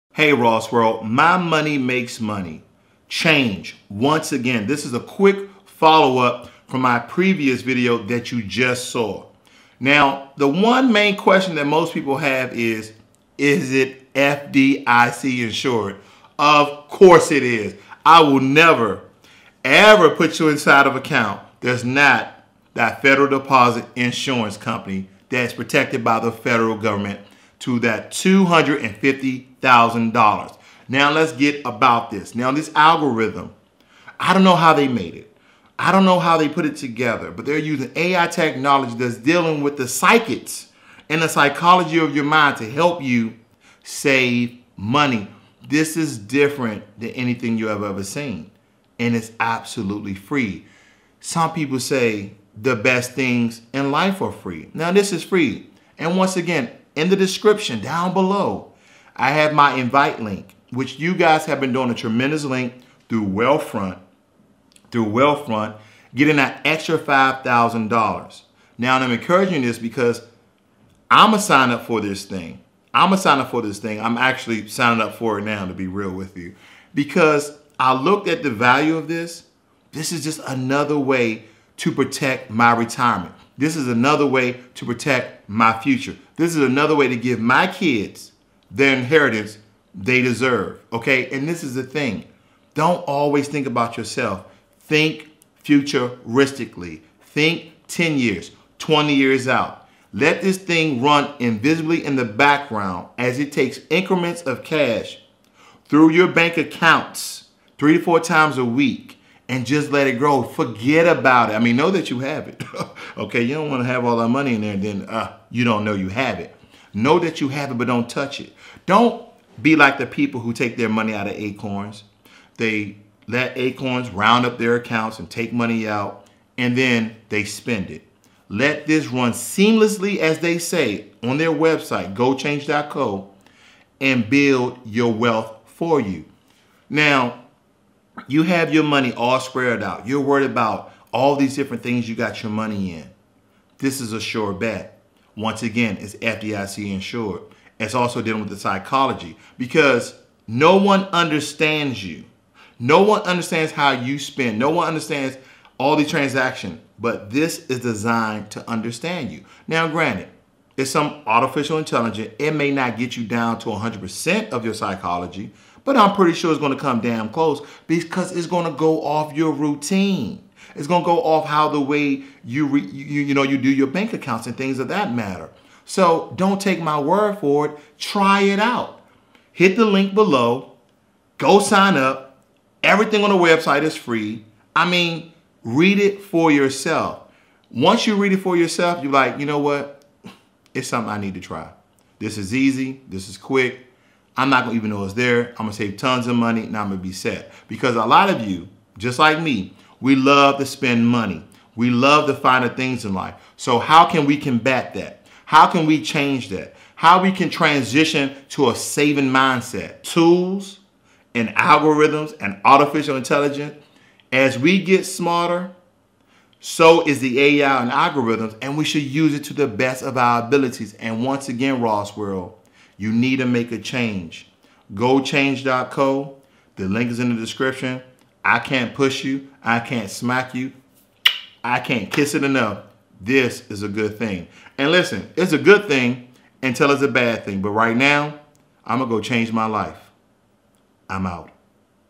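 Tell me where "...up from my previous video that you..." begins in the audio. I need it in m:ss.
0:06.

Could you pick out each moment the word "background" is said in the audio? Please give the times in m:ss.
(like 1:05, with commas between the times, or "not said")
1:42.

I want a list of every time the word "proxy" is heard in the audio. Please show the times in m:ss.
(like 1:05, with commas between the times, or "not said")
not said.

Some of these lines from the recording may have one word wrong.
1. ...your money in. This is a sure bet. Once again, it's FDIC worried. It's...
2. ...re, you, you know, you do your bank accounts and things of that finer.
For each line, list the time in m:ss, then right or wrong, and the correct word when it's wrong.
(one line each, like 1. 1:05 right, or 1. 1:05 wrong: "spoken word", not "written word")
1. 2:22 wrong: "insured", not "worried"
2. 2:52 wrong: "matter", not "finer".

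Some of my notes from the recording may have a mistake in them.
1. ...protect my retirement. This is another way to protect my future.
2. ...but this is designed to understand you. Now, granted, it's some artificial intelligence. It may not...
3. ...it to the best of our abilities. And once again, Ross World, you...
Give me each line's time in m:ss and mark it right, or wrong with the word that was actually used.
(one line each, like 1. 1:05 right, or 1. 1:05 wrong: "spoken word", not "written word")
1. 1:21 right
2. 2:36 right
3. 3:39 right.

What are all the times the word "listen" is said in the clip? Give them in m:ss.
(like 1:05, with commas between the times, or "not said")
3:54.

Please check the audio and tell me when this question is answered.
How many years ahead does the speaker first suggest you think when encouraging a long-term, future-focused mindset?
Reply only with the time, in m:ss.
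1:37.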